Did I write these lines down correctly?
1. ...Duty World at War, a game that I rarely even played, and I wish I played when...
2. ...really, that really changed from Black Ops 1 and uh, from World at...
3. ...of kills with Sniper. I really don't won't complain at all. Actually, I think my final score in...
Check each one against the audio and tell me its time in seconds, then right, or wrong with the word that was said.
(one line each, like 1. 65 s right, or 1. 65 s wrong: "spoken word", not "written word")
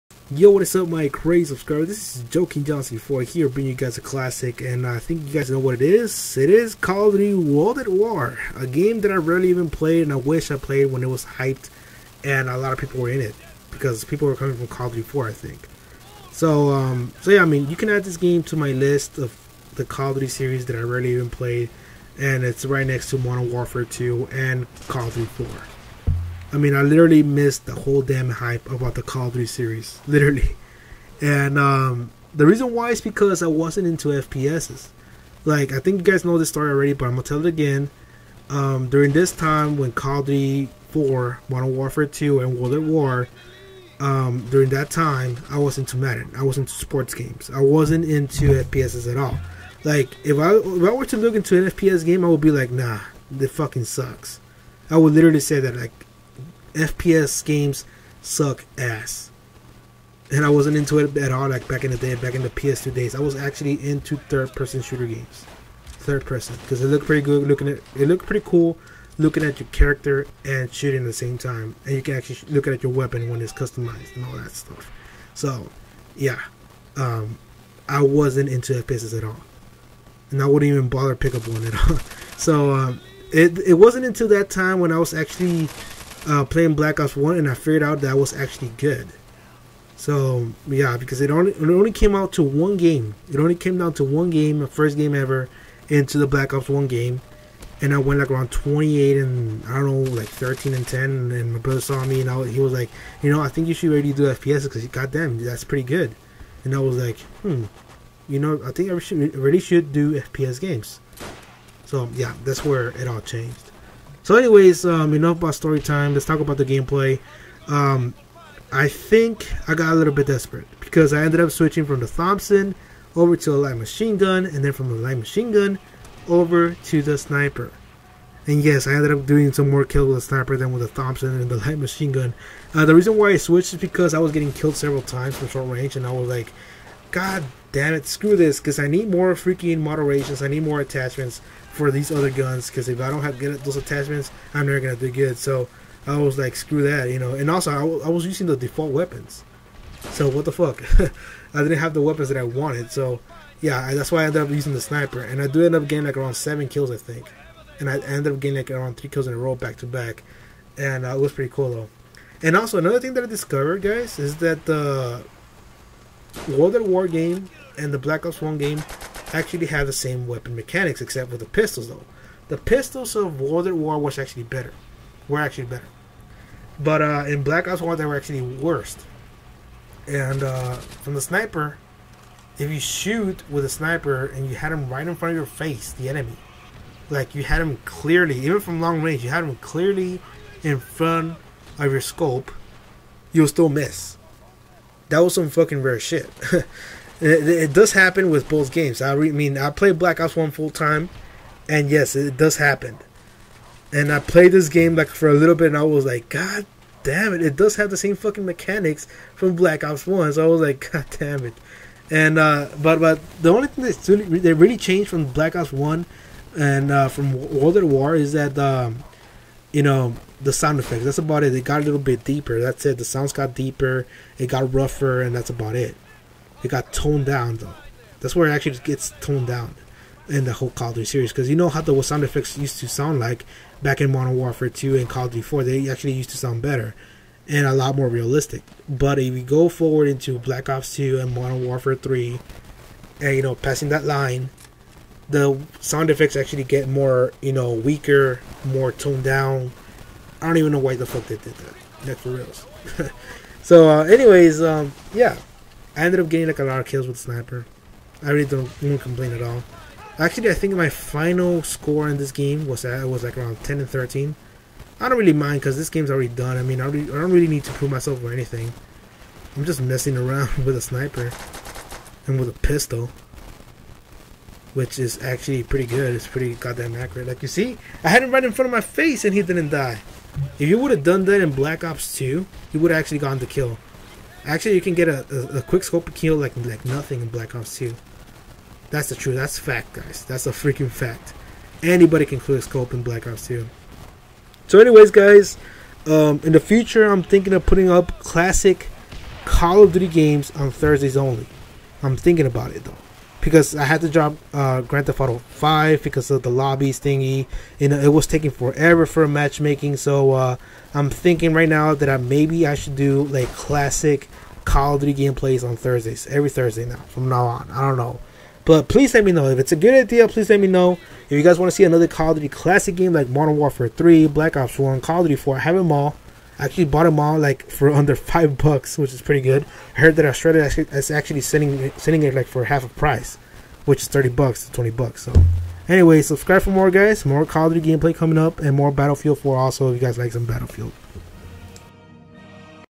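1. 7 s right
2. 214 s right
3. 256 s right.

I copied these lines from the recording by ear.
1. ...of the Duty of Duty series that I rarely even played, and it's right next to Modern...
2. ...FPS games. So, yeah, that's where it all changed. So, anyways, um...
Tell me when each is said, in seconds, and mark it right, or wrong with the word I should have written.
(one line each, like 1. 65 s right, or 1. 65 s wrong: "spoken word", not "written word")
1. 19 s wrong: "Call", not "Duty"
2. 110 s right.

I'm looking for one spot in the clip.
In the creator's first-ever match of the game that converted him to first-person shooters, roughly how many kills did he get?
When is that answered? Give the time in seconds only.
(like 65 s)
98 s.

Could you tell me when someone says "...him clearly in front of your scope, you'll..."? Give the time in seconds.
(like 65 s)
189 s.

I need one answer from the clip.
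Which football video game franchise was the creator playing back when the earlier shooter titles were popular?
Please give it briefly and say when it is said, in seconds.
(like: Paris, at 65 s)
Madden, at 45 s.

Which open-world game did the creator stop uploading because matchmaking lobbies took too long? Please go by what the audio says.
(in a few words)
Grand Theft Auto 5.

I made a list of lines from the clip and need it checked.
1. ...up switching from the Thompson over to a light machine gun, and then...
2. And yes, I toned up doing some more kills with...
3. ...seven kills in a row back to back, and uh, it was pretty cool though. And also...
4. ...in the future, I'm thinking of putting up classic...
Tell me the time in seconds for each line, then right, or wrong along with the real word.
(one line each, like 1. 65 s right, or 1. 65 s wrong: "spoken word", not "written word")
1. 121 s right
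2. 128 s wrong: "ended", not "toned"
3. 158 s wrong: "three", not "seven"
4. 296 s right.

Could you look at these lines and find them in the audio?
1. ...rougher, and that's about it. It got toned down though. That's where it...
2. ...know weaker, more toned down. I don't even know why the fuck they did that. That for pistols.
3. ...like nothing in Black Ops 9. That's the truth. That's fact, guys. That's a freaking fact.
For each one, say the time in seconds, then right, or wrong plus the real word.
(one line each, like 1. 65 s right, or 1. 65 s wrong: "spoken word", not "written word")
1. 224 s right
2. 247 s wrong: "reals", not "pistols"
3. 286 s wrong: "2", not "9".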